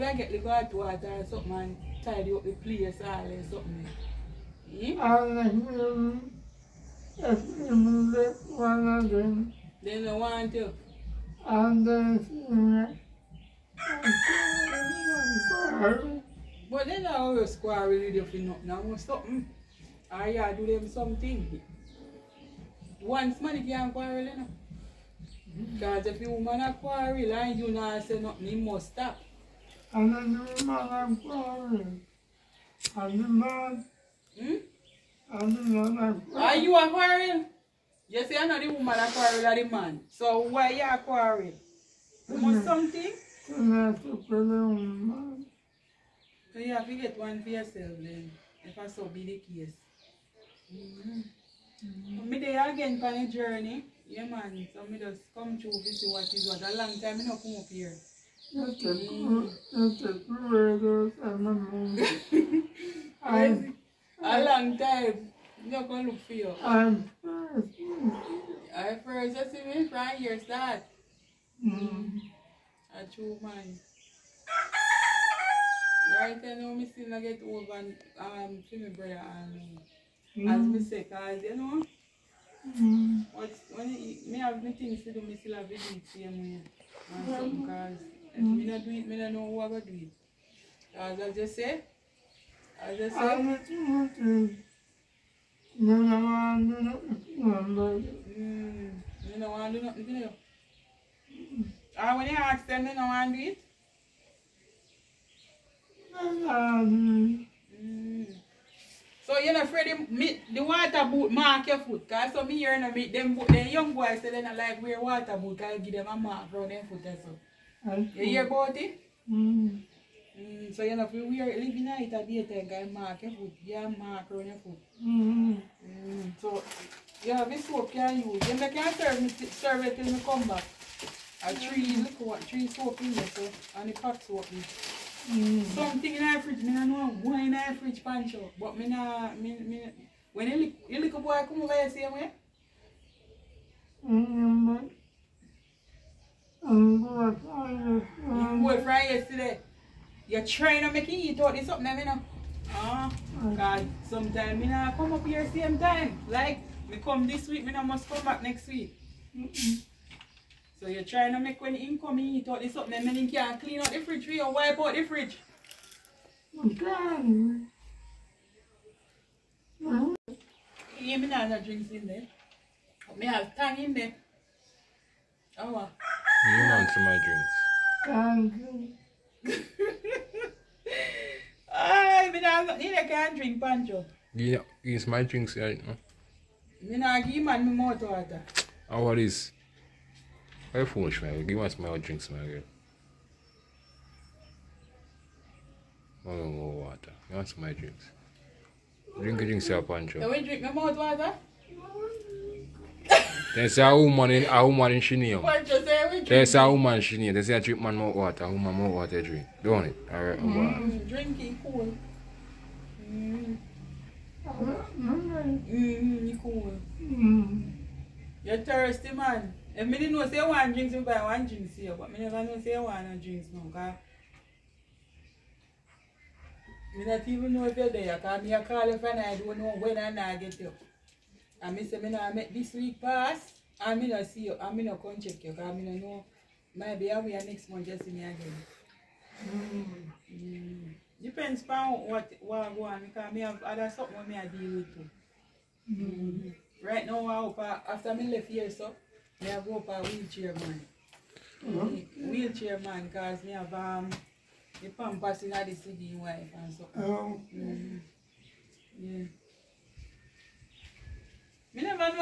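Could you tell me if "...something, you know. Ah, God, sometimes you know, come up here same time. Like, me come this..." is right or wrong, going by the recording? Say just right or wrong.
right.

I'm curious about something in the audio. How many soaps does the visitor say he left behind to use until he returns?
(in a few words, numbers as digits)
3.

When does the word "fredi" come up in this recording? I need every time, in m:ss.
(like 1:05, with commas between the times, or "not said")
1:49.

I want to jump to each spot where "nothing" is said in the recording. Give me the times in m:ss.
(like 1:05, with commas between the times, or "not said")
0:18, 0:28.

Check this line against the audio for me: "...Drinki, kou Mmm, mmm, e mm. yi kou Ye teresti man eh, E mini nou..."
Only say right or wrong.
right.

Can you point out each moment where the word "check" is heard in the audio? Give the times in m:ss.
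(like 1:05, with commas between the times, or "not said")
3:55.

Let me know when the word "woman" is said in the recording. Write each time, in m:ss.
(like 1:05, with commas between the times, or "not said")
0:26, 0:30, 0:38.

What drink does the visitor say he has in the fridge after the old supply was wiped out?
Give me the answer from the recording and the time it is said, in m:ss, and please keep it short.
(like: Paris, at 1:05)
Tang, at 2:53.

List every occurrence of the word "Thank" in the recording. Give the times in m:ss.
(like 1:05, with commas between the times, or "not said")
2:58.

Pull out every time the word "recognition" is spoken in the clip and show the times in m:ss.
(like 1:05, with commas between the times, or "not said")
not said.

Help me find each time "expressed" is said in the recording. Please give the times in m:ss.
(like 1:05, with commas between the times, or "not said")
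not said.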